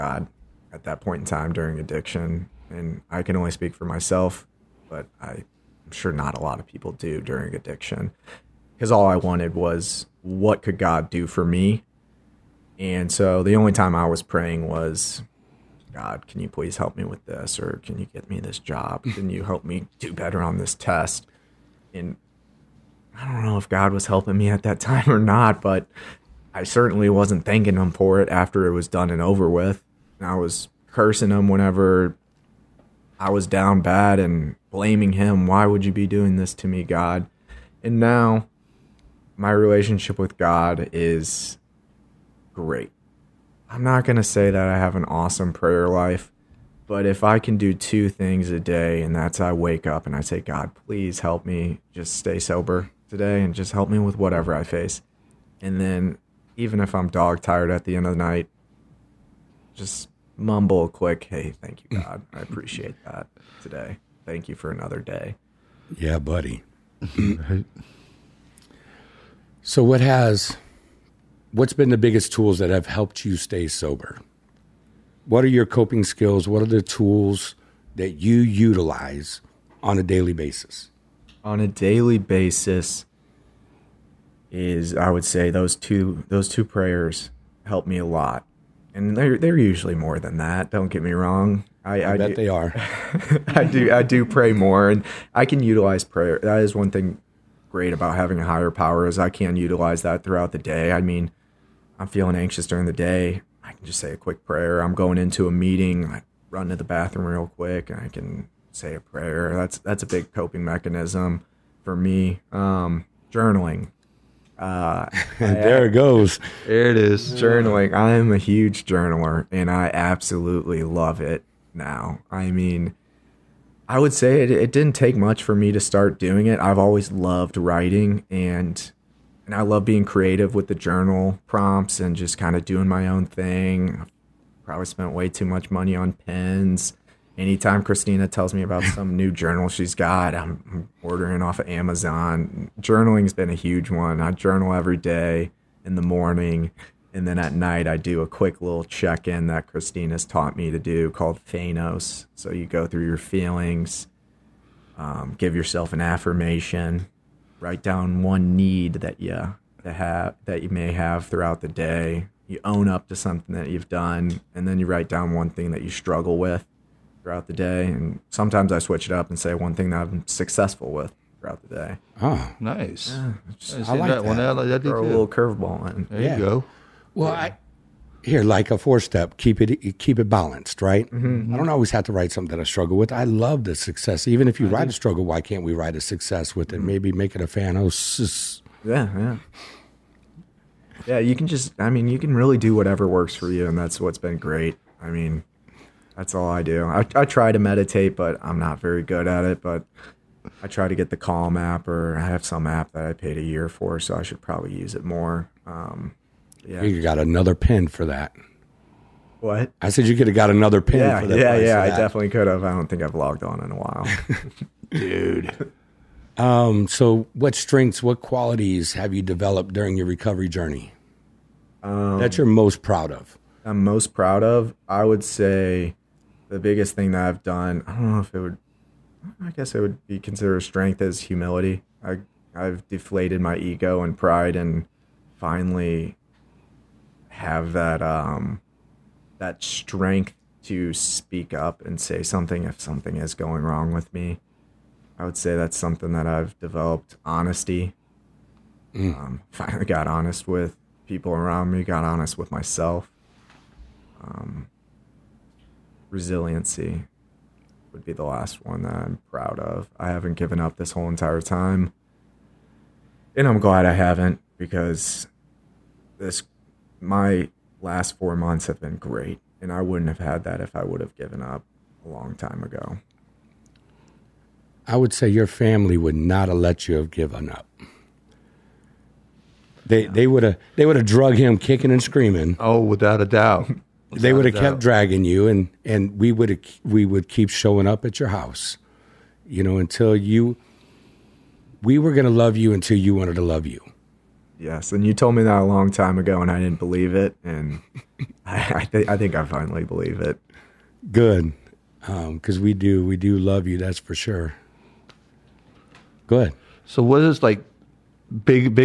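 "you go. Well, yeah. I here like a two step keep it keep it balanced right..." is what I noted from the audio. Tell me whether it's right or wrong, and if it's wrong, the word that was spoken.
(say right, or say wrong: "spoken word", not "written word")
wrong: "four", not "two".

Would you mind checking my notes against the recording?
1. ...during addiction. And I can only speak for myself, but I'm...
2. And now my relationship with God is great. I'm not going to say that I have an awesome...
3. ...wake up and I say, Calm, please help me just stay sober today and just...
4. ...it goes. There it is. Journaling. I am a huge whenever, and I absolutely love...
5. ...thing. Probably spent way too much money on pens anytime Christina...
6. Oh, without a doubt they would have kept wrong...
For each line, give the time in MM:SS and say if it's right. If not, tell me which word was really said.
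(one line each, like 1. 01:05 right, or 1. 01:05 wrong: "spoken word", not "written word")
1. 00:01 right
2. 00:37 right
3. 00:49 wrong: "God", not "Calm"
4. 01:55 wrong: "journaler", not "whenever"
5. 02:13 right
6. 04:42 wrong: "dragging", not "wrong".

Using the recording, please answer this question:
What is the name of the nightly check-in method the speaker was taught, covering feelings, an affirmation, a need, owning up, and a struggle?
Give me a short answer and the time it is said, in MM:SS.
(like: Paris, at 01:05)
FANOS, at 02:31.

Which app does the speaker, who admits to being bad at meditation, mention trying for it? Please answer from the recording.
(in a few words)
Calm.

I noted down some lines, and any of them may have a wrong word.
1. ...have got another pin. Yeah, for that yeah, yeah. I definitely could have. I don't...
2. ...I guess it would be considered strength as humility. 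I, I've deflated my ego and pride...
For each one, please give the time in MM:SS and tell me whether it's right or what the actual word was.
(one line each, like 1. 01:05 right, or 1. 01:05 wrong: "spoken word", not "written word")
1. 03:30 right
2. 03:49 right.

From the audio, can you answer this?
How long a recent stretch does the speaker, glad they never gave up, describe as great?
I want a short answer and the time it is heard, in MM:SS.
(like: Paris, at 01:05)
4 months, at 04:28.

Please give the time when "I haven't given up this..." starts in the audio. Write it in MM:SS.
04:19.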